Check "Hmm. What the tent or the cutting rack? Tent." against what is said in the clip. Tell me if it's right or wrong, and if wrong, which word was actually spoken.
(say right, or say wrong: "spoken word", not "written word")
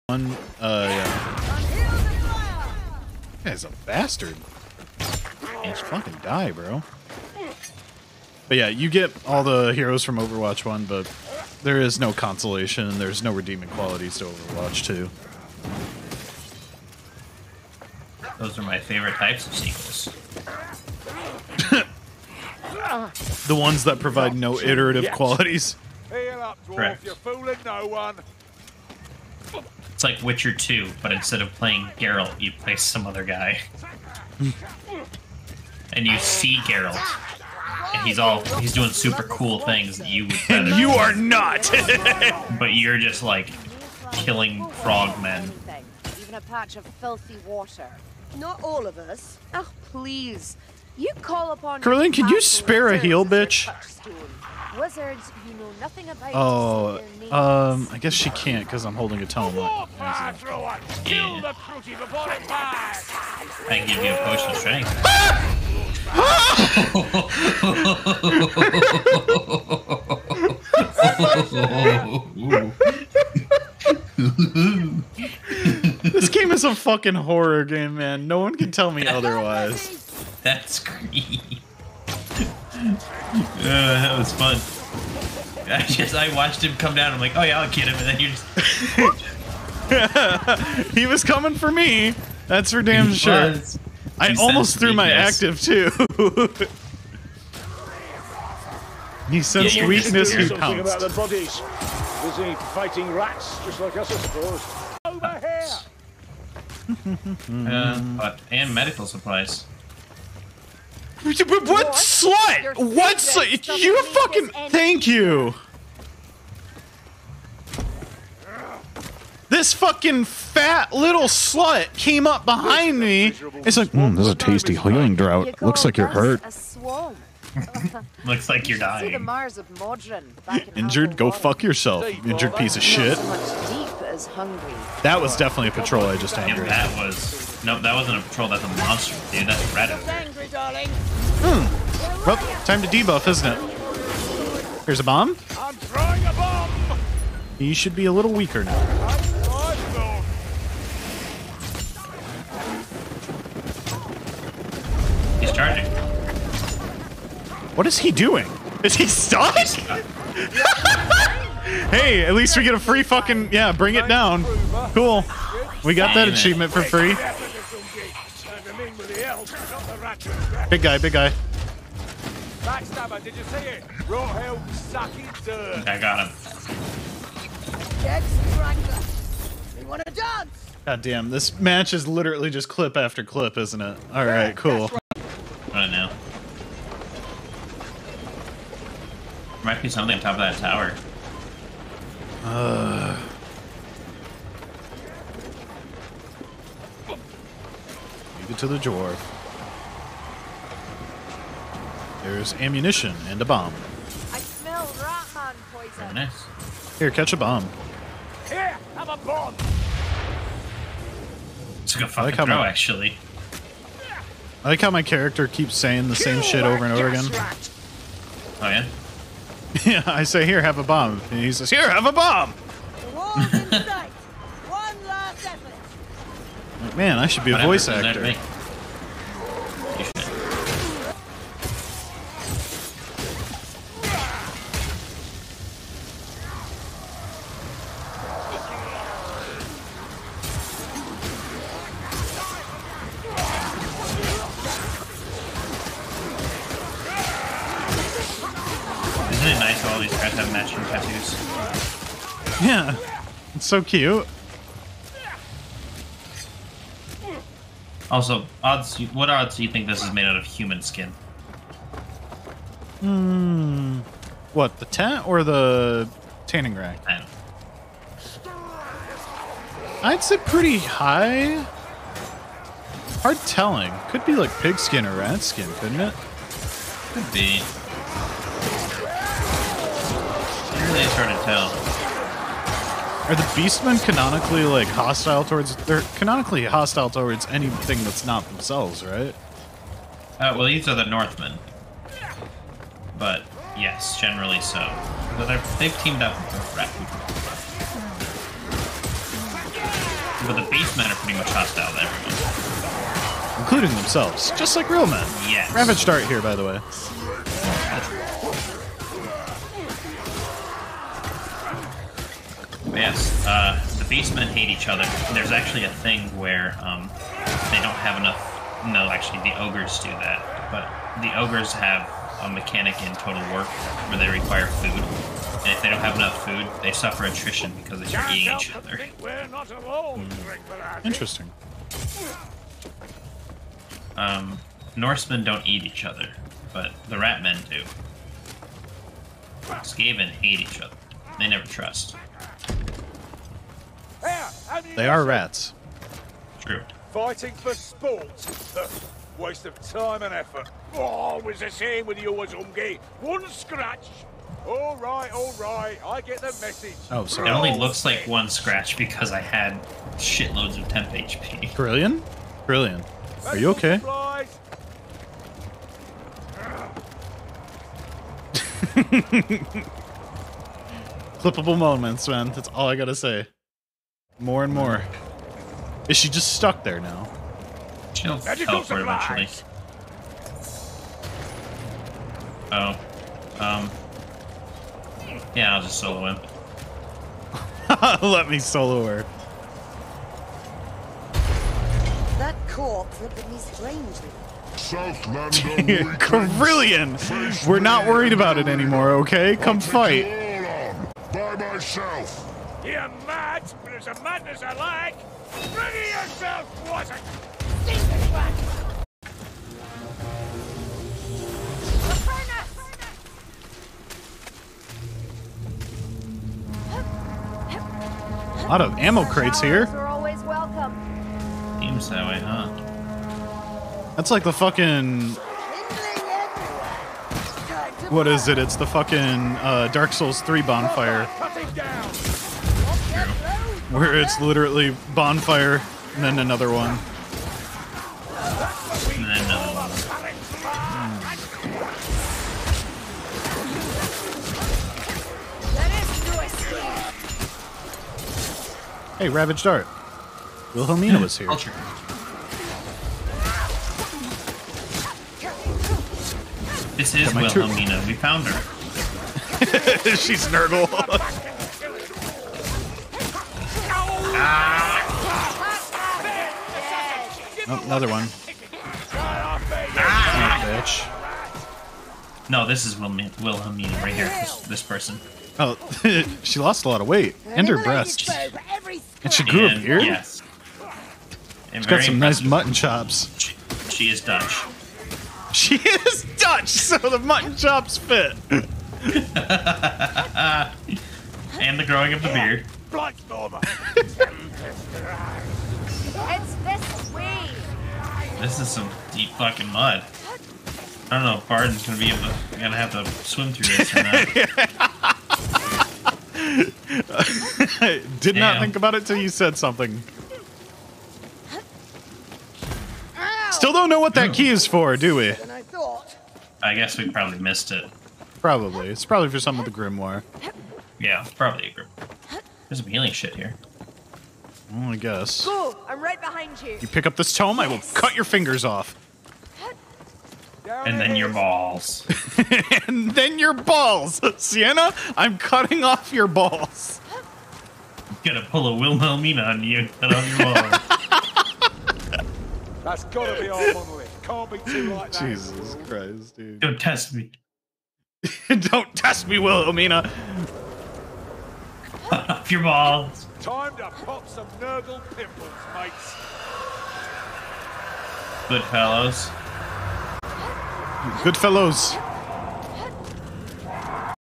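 wrong: "tanning", not "cutting".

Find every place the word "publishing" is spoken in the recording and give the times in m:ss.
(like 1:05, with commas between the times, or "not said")
not said.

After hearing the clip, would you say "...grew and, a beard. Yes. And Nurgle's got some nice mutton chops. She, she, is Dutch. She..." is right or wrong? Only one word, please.
wrong.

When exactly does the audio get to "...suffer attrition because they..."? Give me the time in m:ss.
5:26.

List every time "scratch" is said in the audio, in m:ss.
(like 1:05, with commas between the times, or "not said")
5:53, 5:58.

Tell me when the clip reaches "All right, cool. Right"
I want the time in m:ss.
3:04.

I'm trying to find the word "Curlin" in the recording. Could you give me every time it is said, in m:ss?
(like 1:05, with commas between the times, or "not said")
0:51.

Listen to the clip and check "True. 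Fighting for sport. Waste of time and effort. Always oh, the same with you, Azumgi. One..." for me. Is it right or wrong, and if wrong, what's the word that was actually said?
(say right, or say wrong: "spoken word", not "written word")
right.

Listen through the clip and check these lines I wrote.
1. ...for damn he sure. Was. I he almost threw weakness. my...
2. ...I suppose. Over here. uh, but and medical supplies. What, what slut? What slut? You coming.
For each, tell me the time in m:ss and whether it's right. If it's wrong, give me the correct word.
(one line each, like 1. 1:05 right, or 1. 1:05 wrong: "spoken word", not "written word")
1. 1:32 right
2. 1:44 wrong: "fucking", not "coming".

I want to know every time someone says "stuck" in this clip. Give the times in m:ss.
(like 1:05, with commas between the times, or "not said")
2:39, 6:16.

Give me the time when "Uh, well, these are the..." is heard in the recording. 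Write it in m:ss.
4:50.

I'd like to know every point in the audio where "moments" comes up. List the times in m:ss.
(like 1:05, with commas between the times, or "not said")
6:11.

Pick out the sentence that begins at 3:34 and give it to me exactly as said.
I like how my character keeps saying the same shit over and over again.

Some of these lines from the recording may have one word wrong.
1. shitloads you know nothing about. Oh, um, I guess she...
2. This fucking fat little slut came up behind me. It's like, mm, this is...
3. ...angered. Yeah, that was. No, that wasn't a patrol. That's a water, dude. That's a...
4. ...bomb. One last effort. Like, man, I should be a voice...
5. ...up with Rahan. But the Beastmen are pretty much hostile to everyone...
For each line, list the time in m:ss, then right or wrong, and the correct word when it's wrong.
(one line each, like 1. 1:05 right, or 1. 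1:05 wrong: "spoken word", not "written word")
1. 0:54 wrong: "buzzards", not "shitloads"
2. 1:59 right
3. 2:16 wrong: "monster", not "water"
4. 3:42 right
5. 4:56 wrong: "Rakuten", not "Rahan".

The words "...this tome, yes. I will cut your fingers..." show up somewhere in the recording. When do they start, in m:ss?
8:47.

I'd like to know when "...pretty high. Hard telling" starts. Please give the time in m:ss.
4:30.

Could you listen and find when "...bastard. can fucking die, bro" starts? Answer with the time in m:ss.
0:03.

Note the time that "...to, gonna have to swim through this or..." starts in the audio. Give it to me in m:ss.
8:22.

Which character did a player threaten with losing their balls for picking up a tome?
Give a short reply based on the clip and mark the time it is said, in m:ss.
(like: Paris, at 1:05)
Sienna, at 8:54.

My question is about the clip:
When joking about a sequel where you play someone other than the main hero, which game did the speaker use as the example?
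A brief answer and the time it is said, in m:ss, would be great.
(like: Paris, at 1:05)
Witcher 2, at 0:30.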